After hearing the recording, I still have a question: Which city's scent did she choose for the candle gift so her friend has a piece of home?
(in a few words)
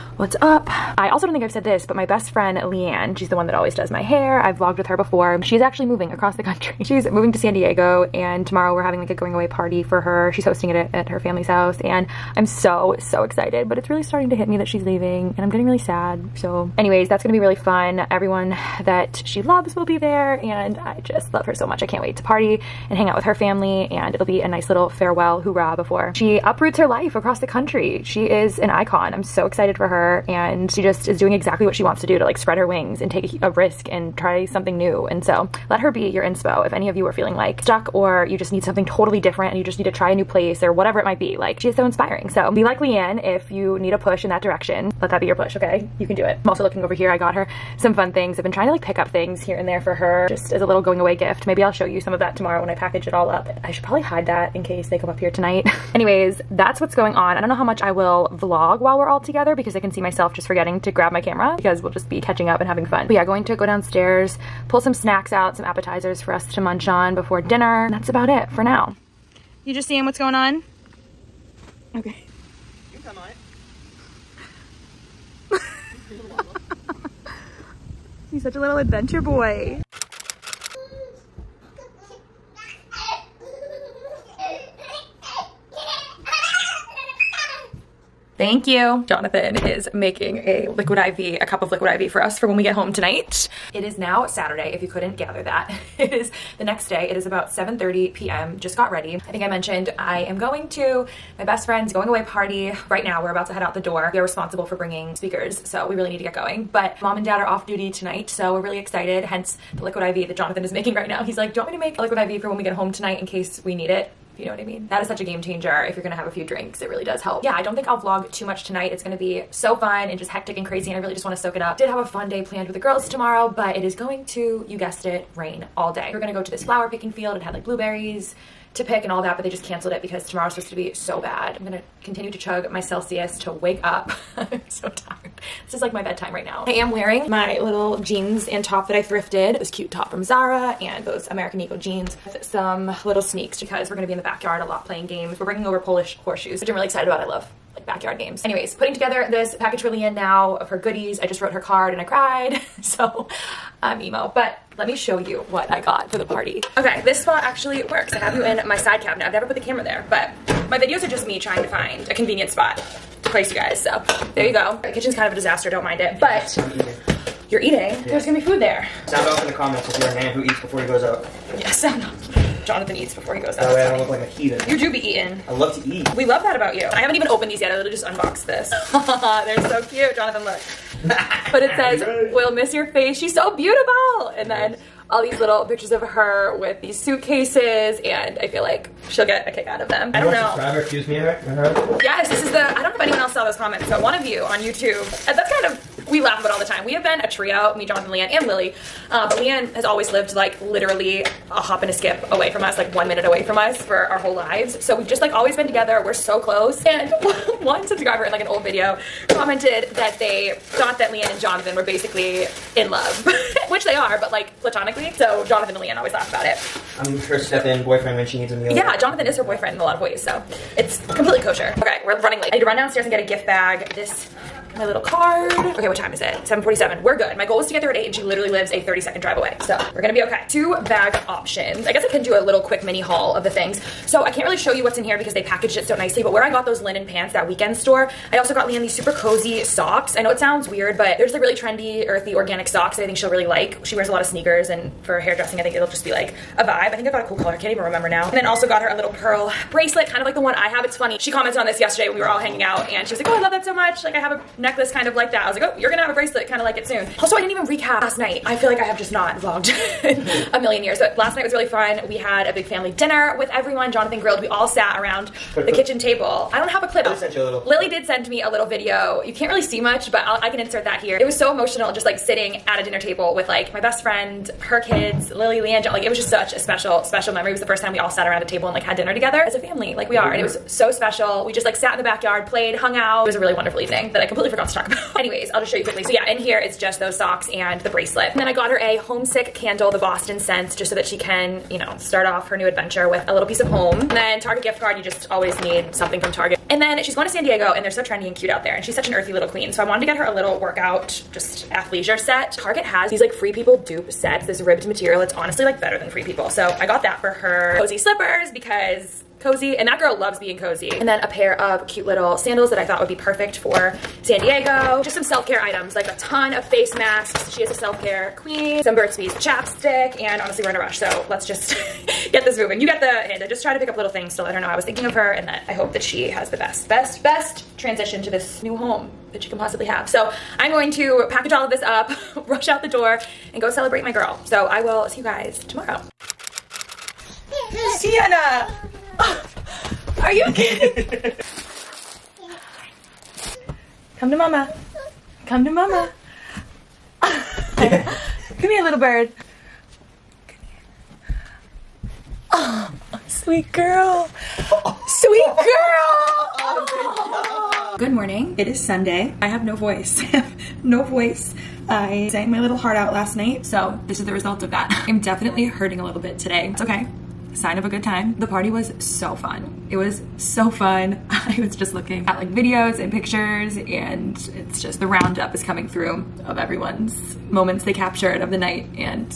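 Boston.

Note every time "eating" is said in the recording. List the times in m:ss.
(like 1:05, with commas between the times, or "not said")
2:47, 2:54.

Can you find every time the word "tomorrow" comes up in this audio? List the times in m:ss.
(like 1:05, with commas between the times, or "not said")
0:08, 0:52, 2:03, 2:10, 5:35.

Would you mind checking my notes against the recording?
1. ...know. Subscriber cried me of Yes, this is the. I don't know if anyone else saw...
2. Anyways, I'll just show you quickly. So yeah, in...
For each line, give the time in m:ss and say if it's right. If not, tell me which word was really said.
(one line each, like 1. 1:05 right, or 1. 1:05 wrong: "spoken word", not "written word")
1. 3:10 wrong: "accused", not "cried"
2. 4:45 right.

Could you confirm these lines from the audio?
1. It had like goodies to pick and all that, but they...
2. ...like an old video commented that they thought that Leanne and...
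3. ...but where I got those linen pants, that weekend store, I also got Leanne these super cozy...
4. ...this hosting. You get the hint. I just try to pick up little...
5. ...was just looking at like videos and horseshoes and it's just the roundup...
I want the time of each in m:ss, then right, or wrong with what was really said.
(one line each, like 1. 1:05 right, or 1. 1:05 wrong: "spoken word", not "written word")
1. 2:07 wrong: "blueberries", not "goodies"
2. 3:28 right
3. 3:56 right
4. 5:22 wrong: "moving", not "hosting"
5. 6:11 wrong: "pictures", not "horseshoes".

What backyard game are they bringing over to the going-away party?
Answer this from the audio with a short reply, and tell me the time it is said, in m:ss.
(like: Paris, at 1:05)
Polish horseshoes, at 2:25.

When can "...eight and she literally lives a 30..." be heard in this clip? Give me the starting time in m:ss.
3:47.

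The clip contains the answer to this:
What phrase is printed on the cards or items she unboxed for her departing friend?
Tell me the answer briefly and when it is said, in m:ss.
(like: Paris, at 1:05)
We'll miss your face, at 3:02.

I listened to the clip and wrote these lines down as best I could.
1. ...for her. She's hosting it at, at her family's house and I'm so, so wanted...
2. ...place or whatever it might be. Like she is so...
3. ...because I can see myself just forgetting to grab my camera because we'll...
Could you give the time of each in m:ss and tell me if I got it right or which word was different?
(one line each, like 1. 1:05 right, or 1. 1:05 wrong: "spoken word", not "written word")
1. 0:09 wrong: "excited", not "wanted"
2. 0:40 right
3. 0:59 right.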